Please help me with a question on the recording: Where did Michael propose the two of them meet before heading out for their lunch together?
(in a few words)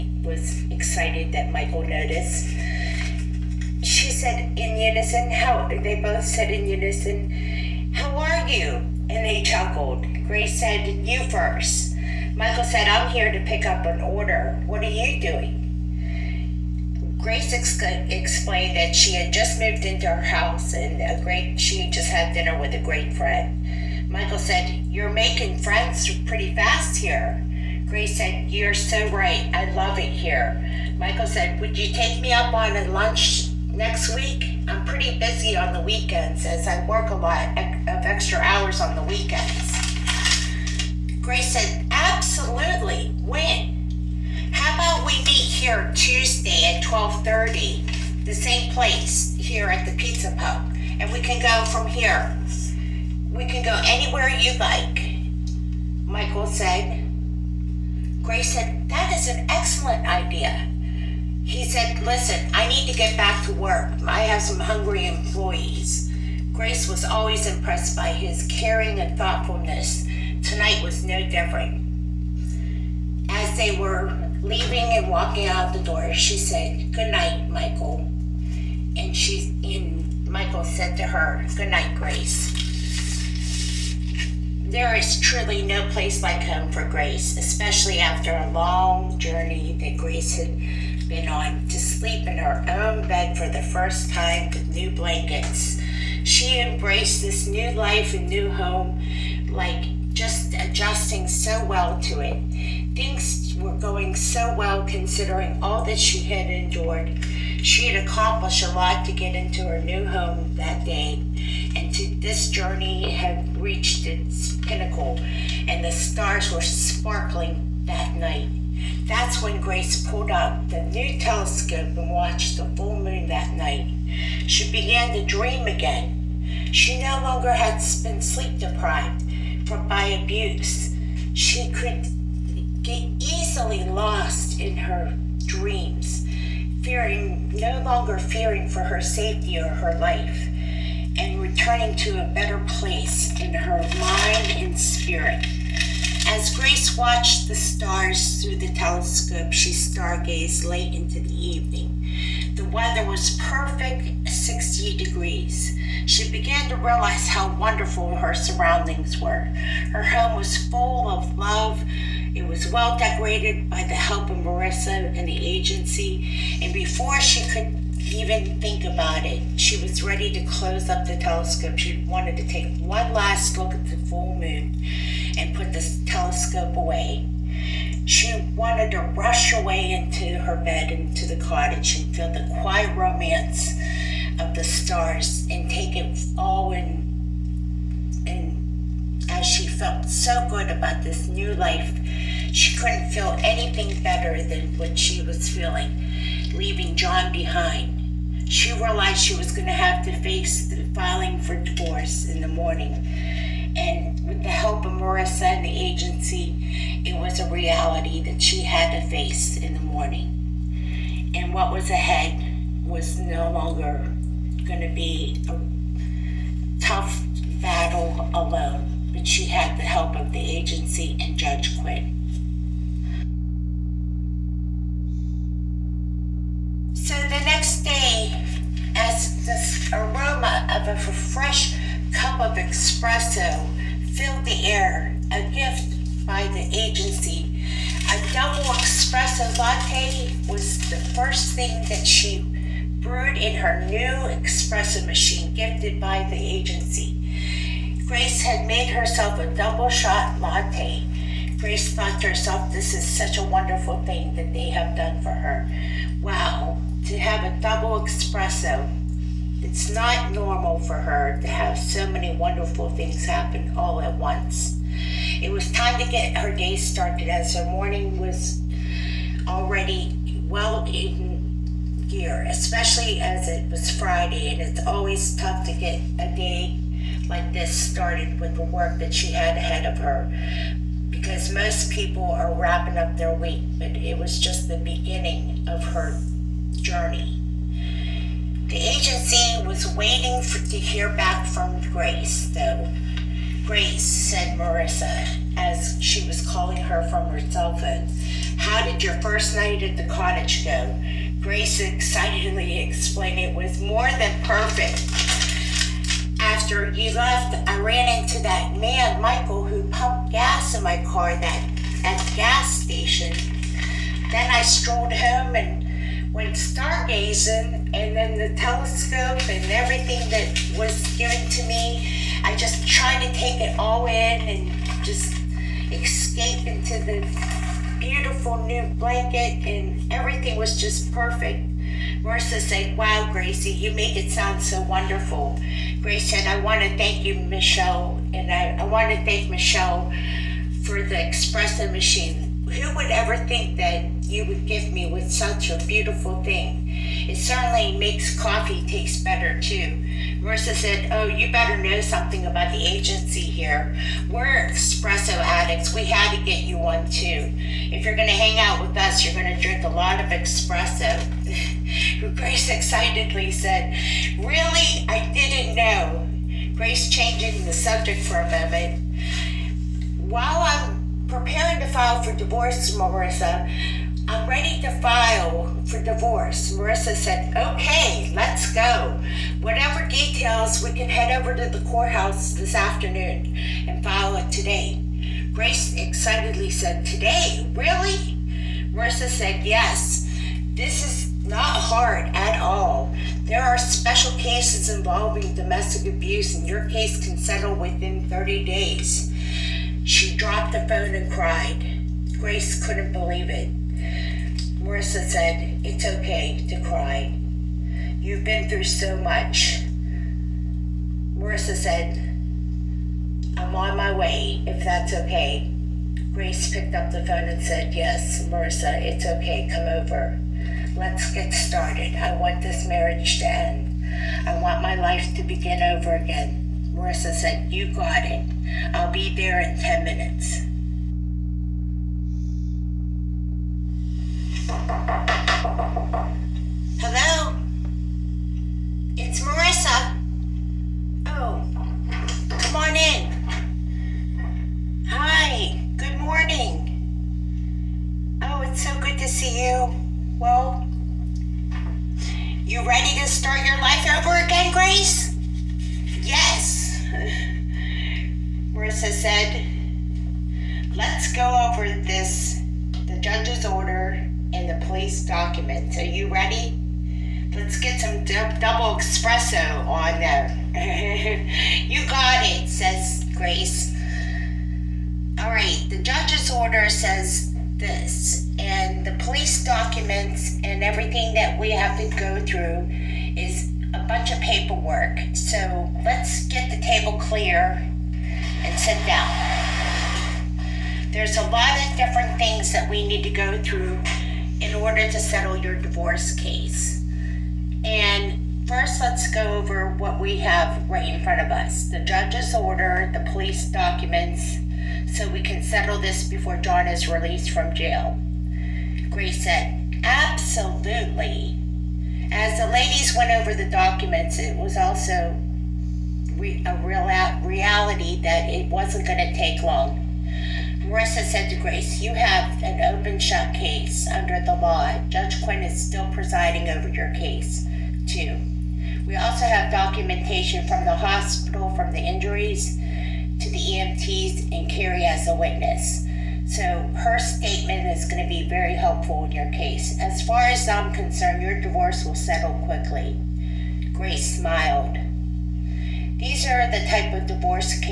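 Pizza Pub.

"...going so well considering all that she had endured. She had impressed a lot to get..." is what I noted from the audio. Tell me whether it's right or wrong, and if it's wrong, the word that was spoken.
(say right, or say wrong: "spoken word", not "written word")
wrong: "accomplished", not "impressed".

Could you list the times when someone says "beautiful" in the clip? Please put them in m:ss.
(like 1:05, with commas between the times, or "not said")
5:27, 5:45.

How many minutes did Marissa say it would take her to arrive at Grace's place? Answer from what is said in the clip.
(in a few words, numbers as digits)
10 minutes.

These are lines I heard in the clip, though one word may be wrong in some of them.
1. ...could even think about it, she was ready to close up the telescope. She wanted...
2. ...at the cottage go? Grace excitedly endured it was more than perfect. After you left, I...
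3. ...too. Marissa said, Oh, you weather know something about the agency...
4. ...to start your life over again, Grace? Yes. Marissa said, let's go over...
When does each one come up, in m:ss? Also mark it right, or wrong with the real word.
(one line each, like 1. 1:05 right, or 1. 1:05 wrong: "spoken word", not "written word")
1. 2:47 right
2. 4:59 wrong: "explained", not "endured"
3. 5:49 wrong: "better", not "weather"
4. 7:33 right.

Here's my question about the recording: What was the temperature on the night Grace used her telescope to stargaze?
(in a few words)
60 degrees.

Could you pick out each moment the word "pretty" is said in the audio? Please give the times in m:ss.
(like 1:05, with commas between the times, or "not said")
0:26, 0:34.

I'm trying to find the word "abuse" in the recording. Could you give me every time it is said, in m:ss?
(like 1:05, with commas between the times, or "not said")
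2:10, 6:36.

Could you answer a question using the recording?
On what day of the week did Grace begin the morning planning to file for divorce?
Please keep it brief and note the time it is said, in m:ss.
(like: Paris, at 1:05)
Friday, at 4:33.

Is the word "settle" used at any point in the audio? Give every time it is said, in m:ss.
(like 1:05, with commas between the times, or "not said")
6:37, 8:15, 8:25, 9:02.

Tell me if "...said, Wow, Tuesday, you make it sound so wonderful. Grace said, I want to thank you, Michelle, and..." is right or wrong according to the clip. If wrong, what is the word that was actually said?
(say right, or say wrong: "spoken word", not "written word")
wrong: "Gracie", not "Tuesday".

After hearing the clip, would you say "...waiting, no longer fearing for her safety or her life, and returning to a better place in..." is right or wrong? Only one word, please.
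wrong.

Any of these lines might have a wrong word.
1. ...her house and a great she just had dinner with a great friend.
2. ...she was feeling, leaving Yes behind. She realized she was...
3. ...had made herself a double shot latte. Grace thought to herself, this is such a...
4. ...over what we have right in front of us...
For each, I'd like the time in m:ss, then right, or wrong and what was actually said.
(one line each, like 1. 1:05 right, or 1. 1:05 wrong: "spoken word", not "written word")
1. 0:20 right
2. 3:14 wrong: "John", not "Yes"
3. 4:08 right
4. 8:19 right.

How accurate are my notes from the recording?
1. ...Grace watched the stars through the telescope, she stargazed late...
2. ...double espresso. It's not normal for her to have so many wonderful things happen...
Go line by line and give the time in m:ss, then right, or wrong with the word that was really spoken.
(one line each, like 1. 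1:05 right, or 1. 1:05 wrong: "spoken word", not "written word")
1. 2:26 right
2. 4:17 right.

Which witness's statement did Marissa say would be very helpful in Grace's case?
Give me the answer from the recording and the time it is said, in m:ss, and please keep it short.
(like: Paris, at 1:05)
Carrie, at 8:54.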